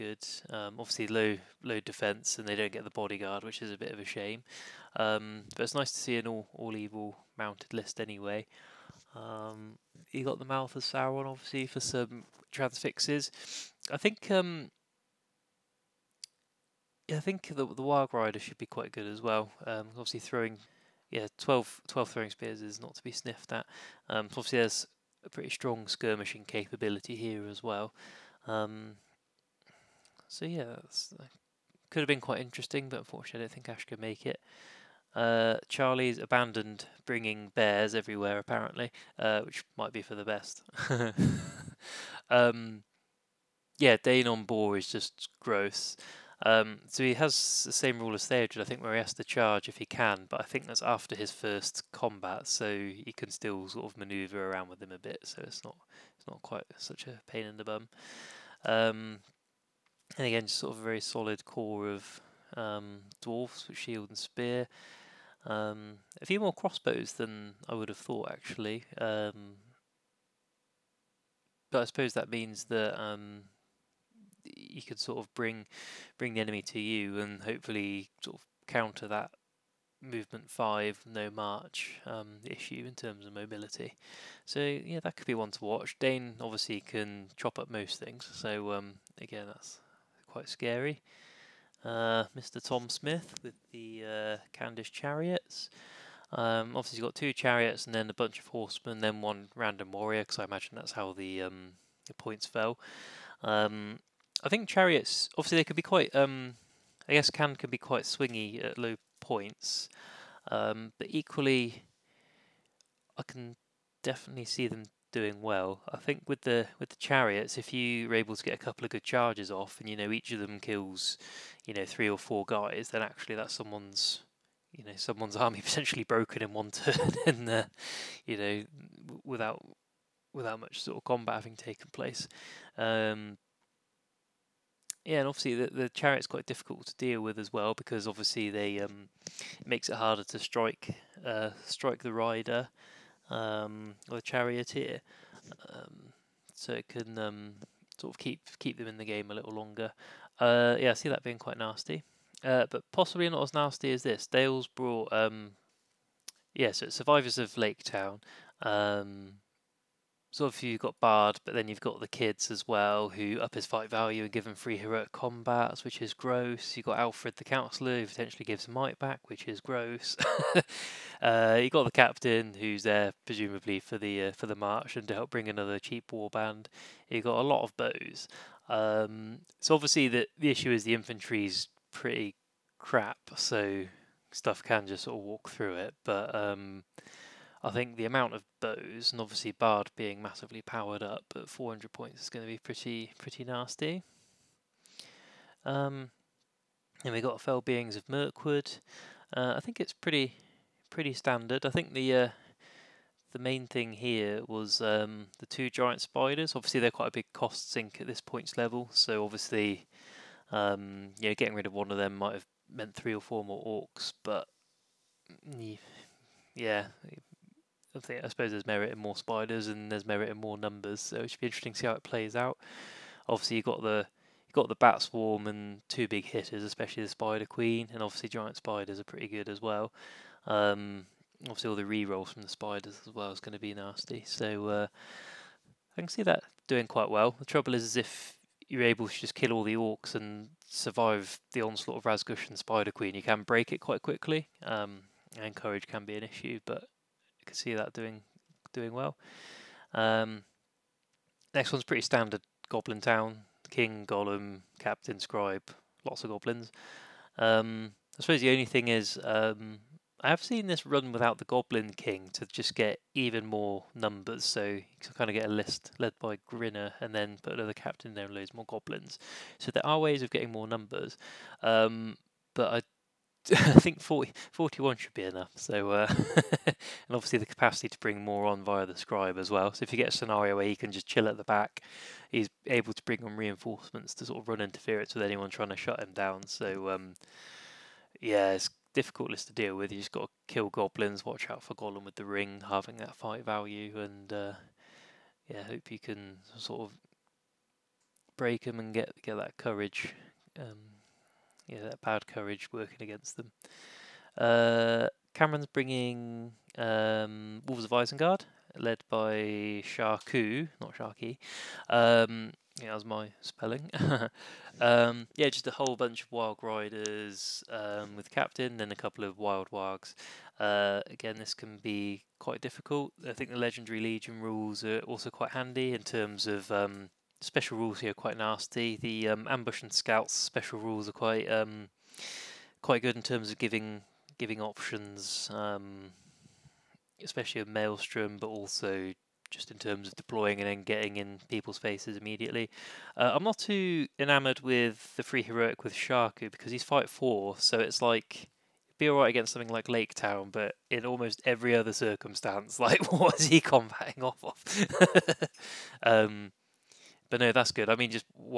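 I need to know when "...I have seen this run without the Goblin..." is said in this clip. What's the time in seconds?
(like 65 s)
260 s.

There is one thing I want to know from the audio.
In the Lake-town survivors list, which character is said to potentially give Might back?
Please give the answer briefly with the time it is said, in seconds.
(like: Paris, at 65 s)
Alfrid the Counselor, at 166 s.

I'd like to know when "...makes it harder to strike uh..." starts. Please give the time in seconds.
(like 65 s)
139 s.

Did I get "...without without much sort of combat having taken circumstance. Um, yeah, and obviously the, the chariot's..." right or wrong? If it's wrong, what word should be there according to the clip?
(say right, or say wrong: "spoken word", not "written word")
wrong: "place", not "circumstance".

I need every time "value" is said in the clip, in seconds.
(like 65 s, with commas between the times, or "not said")
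163 s, 293 s.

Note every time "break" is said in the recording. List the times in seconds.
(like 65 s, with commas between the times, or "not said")
243 s, 298 s.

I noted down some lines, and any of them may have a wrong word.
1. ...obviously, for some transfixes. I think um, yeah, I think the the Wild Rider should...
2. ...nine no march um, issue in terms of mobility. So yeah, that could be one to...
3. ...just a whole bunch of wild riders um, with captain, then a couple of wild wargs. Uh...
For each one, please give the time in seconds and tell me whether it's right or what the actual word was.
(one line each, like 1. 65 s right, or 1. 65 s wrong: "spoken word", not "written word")
1. 11 s right
2. 80 s wrong: "five", not "nine"
3. 315 s right.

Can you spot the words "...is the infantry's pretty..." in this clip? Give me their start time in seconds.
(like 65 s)
180 s.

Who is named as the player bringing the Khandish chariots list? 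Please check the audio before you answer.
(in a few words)
Tom Smith.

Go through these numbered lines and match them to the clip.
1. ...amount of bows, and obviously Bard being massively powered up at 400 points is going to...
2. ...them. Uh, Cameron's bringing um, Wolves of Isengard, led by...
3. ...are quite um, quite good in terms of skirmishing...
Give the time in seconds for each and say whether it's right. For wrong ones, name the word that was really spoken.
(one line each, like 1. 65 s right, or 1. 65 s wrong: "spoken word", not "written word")
1. 188 s right
2. 303 s right
3. 331 s wrong: "giving", not "skirmishing".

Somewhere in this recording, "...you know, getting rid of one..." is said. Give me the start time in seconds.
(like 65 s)
211 s.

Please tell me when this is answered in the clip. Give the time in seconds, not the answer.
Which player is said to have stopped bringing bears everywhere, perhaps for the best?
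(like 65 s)
35 s.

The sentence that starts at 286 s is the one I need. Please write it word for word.
So, um, yeah, it's difficult list to deal with.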